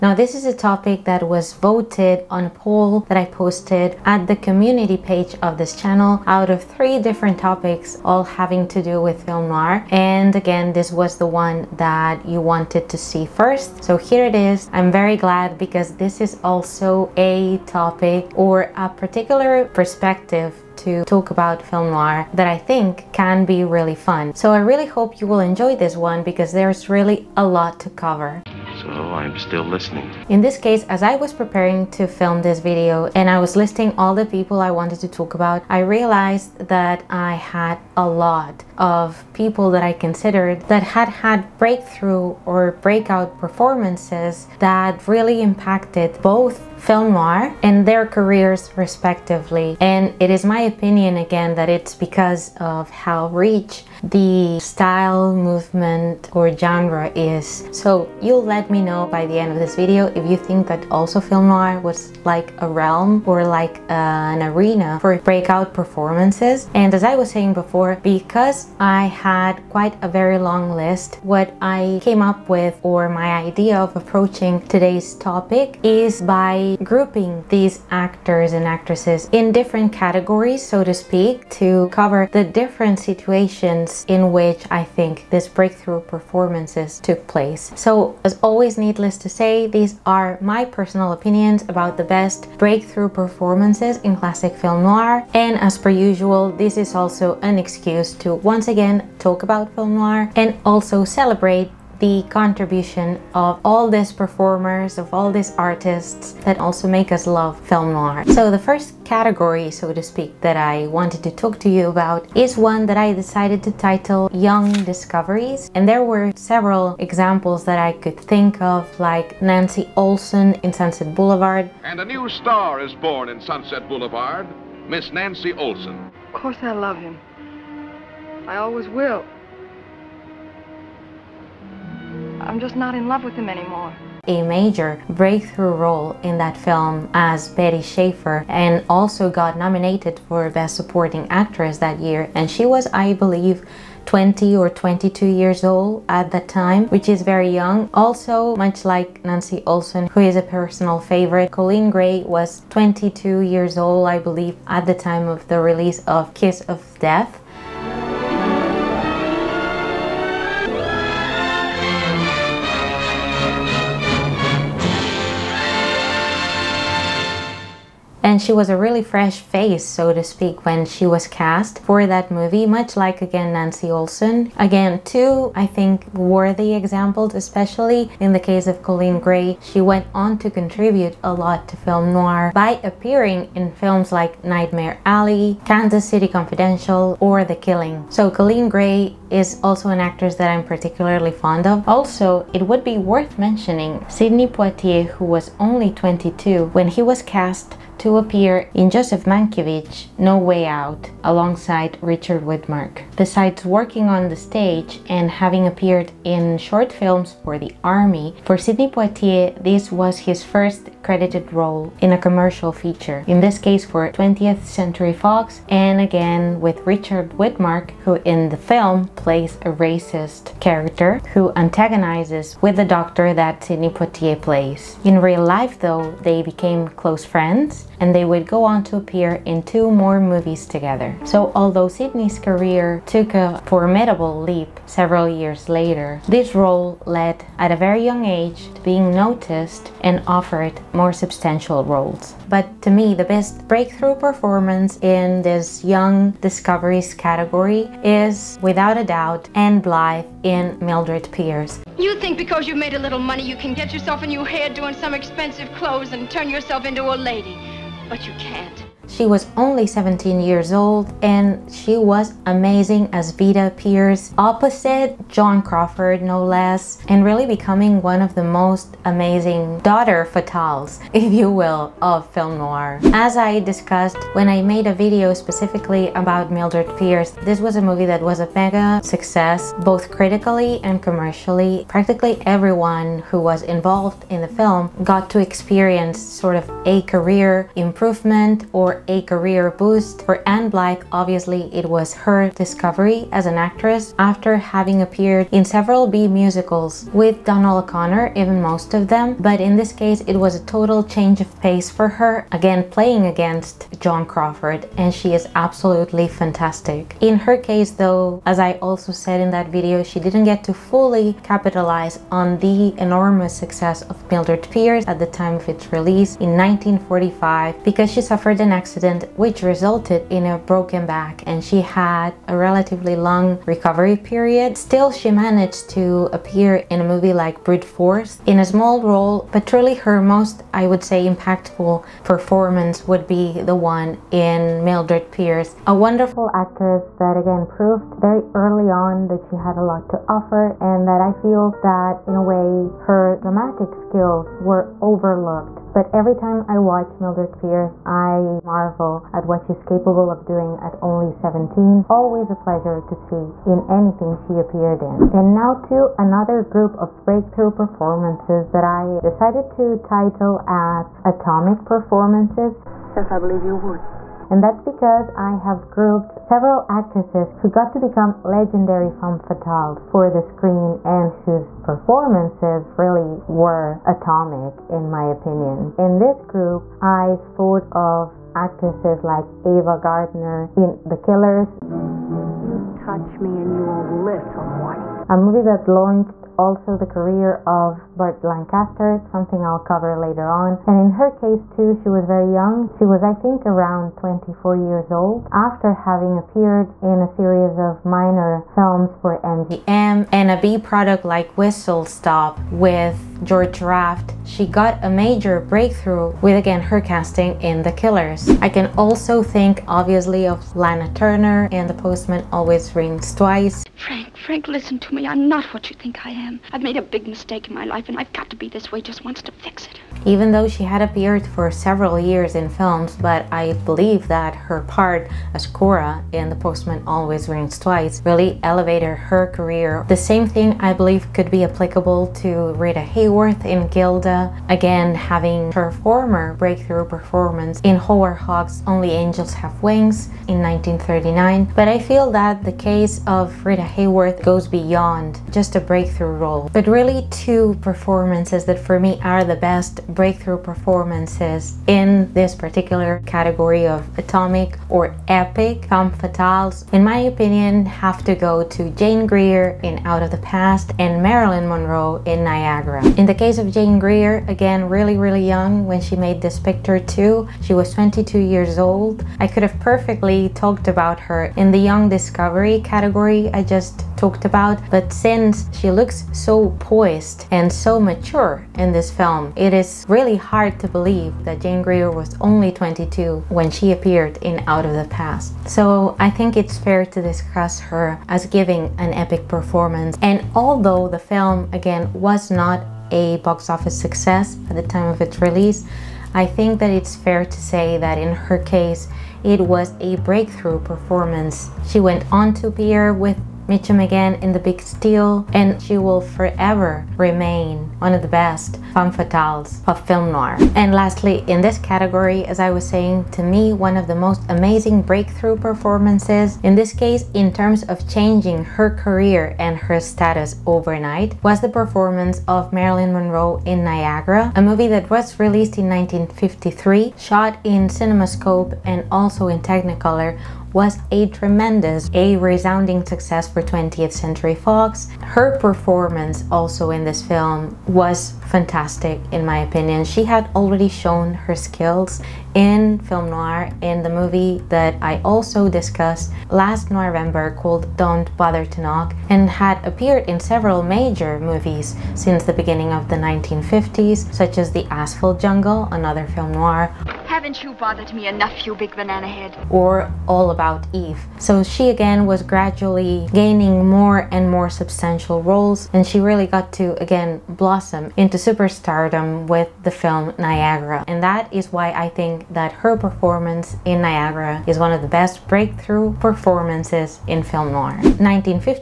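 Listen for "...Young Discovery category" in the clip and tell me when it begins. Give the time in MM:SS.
07:51.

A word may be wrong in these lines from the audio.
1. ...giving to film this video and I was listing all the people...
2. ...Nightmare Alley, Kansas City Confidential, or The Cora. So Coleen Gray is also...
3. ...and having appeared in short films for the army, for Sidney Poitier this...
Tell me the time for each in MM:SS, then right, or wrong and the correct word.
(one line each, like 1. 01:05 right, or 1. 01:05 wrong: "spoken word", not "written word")
1. 00:31 wrong: "preparing", not "giving"
2. 03:04 wrong: "Killing", not "Cora"
3. 03:25 right.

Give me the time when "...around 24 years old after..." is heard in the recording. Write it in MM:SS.
06:33.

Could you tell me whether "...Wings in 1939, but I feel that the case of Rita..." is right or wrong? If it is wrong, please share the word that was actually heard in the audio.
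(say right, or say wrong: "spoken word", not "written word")
right.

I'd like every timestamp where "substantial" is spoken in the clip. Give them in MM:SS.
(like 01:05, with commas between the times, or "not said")
04:01, 09:24.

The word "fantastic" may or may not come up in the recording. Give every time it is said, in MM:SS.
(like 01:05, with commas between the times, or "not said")
05:06, 08:58.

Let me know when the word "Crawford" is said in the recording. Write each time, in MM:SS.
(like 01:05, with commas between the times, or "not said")
04:25, 05:04.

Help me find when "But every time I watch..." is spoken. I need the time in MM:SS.
05:45.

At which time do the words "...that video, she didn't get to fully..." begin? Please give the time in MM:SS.
05:09.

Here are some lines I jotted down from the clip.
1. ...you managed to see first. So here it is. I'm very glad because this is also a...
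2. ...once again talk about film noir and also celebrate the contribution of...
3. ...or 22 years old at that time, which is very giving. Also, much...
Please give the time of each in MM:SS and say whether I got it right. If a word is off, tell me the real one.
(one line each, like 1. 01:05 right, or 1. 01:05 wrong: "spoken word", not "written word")
1. 00:12 wrong: "wanted", not "managed"
2. 01:38 right
3. 02:24 wrong: "young", not "giving".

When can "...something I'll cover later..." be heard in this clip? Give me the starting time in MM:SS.
06:29.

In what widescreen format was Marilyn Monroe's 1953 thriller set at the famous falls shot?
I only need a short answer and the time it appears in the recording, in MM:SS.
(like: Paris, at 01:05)
CinemaScope, at 08:47.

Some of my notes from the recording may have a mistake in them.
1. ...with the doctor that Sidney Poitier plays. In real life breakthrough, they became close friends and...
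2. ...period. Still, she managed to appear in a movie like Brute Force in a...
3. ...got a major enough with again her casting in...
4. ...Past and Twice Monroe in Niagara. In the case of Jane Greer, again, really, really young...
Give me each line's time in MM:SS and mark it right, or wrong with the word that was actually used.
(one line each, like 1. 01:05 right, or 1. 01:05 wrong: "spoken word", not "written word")
1. 03:42 wrong: "though", not "breakthrough"
2. 05:24 right
3. 06:44 wrong: "breakthrough", not "enough"
4. 07:40 wrong: "Marilyn", not "Twice".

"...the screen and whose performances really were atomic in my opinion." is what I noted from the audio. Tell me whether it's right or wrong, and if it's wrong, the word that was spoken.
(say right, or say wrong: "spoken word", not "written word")
right.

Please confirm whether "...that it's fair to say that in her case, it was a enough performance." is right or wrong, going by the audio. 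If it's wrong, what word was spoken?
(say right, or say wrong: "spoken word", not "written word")
wrong: "breakthrough", not "enough".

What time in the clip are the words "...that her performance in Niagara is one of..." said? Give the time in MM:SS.
09:32.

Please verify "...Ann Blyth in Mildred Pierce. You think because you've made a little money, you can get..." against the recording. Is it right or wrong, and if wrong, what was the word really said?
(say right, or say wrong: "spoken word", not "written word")
right.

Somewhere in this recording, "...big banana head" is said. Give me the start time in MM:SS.
09:18.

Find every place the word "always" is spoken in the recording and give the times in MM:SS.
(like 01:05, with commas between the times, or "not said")
01:28, 02:08, 05:52, 06:52, 07:07.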